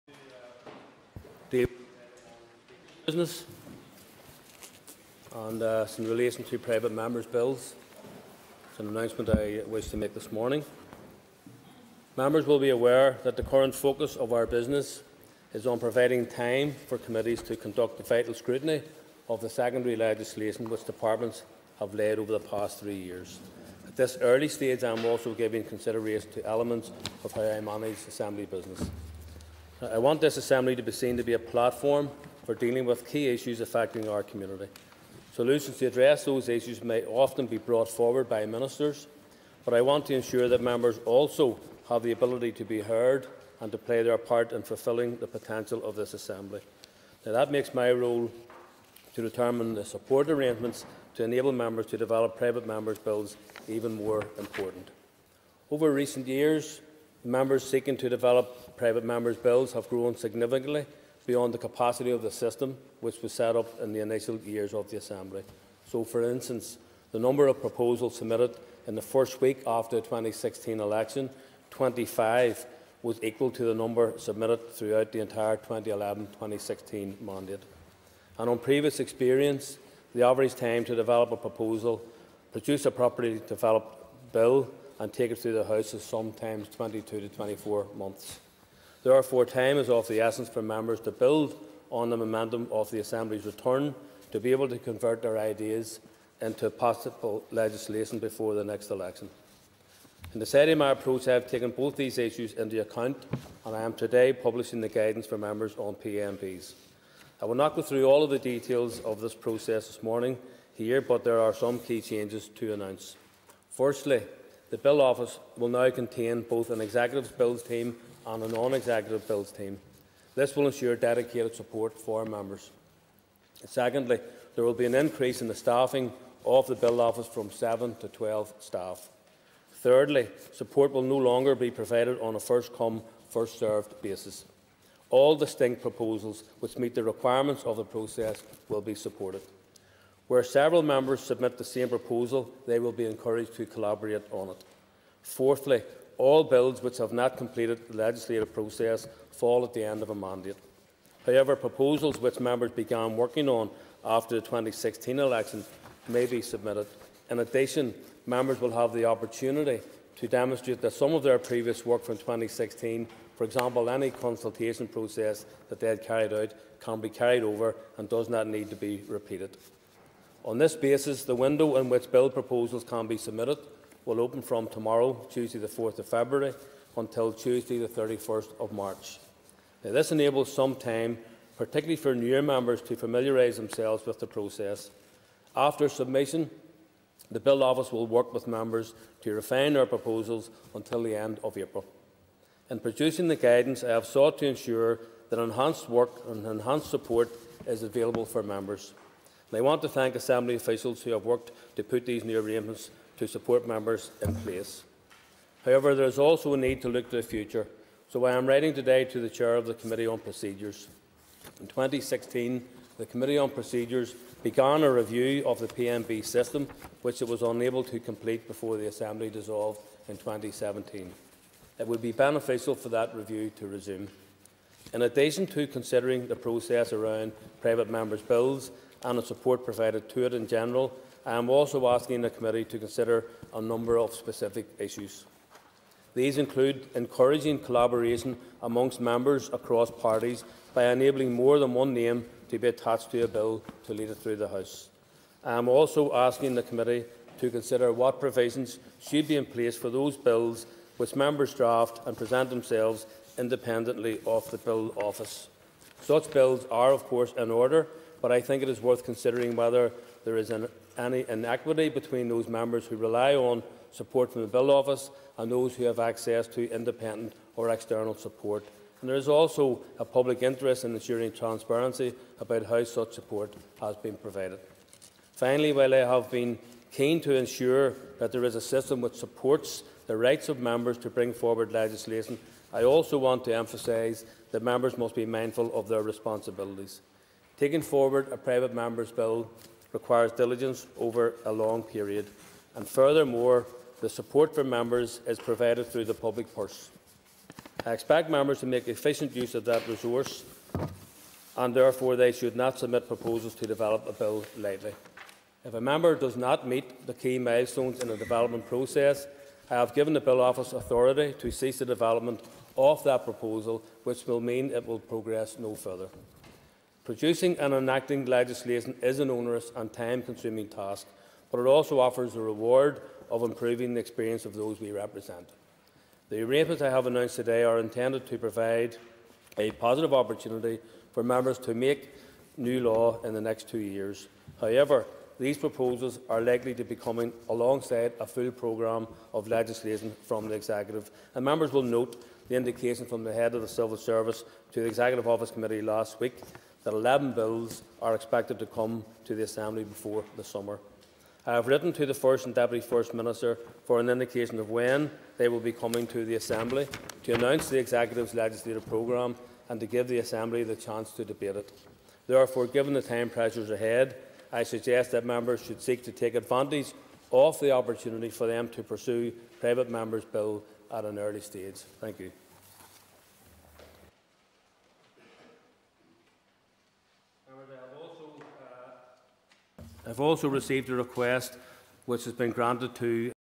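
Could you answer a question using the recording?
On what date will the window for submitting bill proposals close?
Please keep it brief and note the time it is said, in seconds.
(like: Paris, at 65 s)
Tuesday 31 March, at 177 s.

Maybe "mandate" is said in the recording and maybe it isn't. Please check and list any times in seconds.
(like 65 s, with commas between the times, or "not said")
77 s, 150 s.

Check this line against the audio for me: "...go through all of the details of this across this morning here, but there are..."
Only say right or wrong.
wrong.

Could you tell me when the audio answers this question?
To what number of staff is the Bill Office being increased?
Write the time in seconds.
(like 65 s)
128 s.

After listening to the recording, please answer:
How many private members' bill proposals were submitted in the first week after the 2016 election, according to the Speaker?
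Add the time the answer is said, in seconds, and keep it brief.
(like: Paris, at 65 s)
25, at 71 s.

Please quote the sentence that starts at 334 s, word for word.
However, these proposals are likely to be coming alongside a full programme of legislation from the Executive.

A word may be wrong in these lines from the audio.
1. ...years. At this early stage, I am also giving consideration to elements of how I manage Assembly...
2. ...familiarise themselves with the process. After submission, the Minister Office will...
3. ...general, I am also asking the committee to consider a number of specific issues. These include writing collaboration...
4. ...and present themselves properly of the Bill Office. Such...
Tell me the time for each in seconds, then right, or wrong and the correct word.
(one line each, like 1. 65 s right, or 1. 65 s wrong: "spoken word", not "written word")
1. 22 s right
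2. 182 s wrong: "Bill", not "Minister"
3. 230 s wrong: "encouraging", not "writing"
4. 252 s wrong: "independently", not "properly".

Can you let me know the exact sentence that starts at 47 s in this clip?
Now, that makes my role to determine the support arrangements to enable members to develop private members' bills even more important.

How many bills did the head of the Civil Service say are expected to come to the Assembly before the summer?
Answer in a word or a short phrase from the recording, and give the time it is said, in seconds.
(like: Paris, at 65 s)
11, at 346 s.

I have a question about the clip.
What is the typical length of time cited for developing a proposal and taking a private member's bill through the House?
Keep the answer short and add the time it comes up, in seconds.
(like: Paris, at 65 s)
22 to 24 months, at 86 s.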